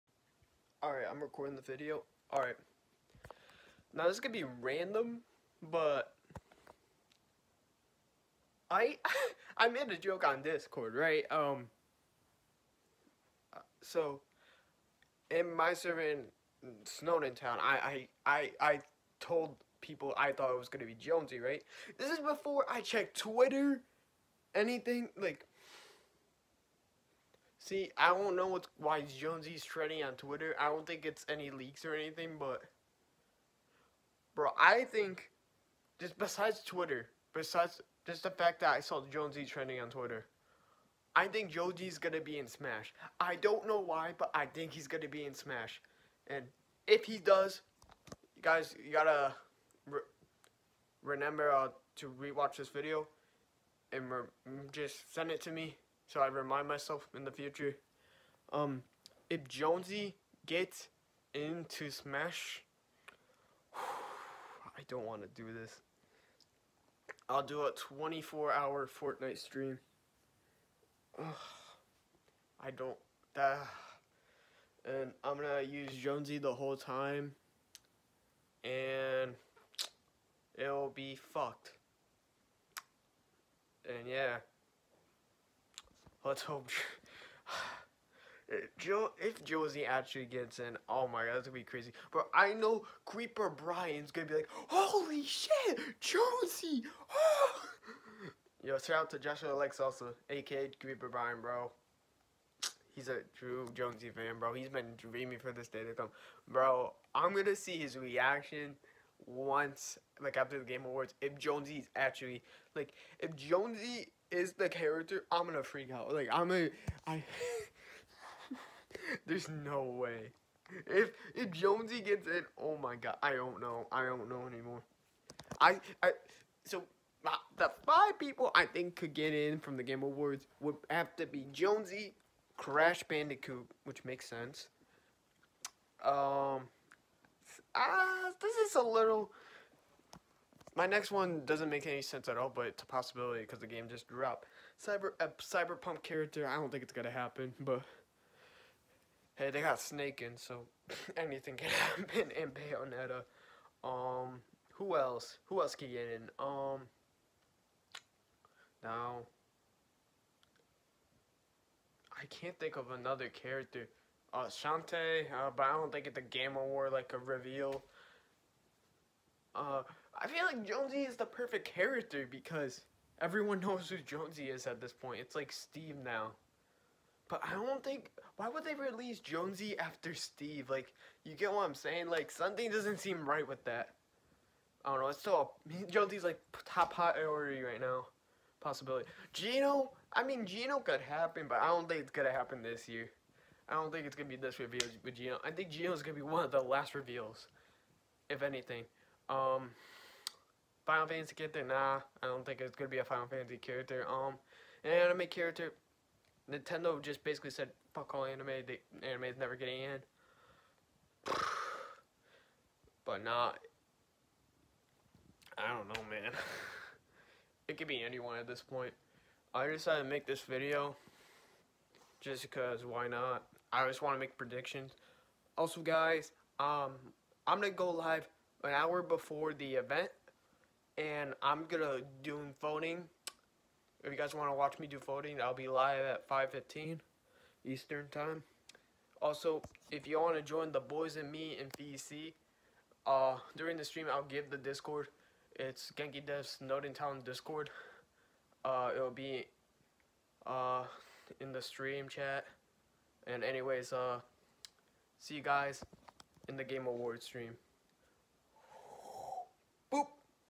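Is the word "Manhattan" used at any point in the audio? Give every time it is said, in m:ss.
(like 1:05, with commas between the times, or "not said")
not said.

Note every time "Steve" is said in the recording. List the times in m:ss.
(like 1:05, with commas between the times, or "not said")
2:55, 3:00.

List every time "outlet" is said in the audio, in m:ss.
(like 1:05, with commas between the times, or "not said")
not said.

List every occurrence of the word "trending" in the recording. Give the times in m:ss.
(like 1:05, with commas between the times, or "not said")
0:29, 0:39.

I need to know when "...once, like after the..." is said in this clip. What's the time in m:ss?
1:49.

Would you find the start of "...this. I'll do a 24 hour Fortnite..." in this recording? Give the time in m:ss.
1:05.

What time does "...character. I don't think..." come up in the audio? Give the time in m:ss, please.
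2:26.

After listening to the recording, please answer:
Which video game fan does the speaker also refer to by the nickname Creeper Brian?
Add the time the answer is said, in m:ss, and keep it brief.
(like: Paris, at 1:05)
Joshua Lex, at 1:39.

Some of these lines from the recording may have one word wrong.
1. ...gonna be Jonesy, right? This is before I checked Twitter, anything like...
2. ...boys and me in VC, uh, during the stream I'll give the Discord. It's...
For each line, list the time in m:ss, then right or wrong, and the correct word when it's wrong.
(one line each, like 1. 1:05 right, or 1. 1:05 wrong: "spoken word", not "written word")
1. 0:20 right
2. 4:00 right.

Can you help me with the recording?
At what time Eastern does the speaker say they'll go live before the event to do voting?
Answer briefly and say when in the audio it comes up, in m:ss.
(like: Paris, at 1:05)
5:15, at 3:56.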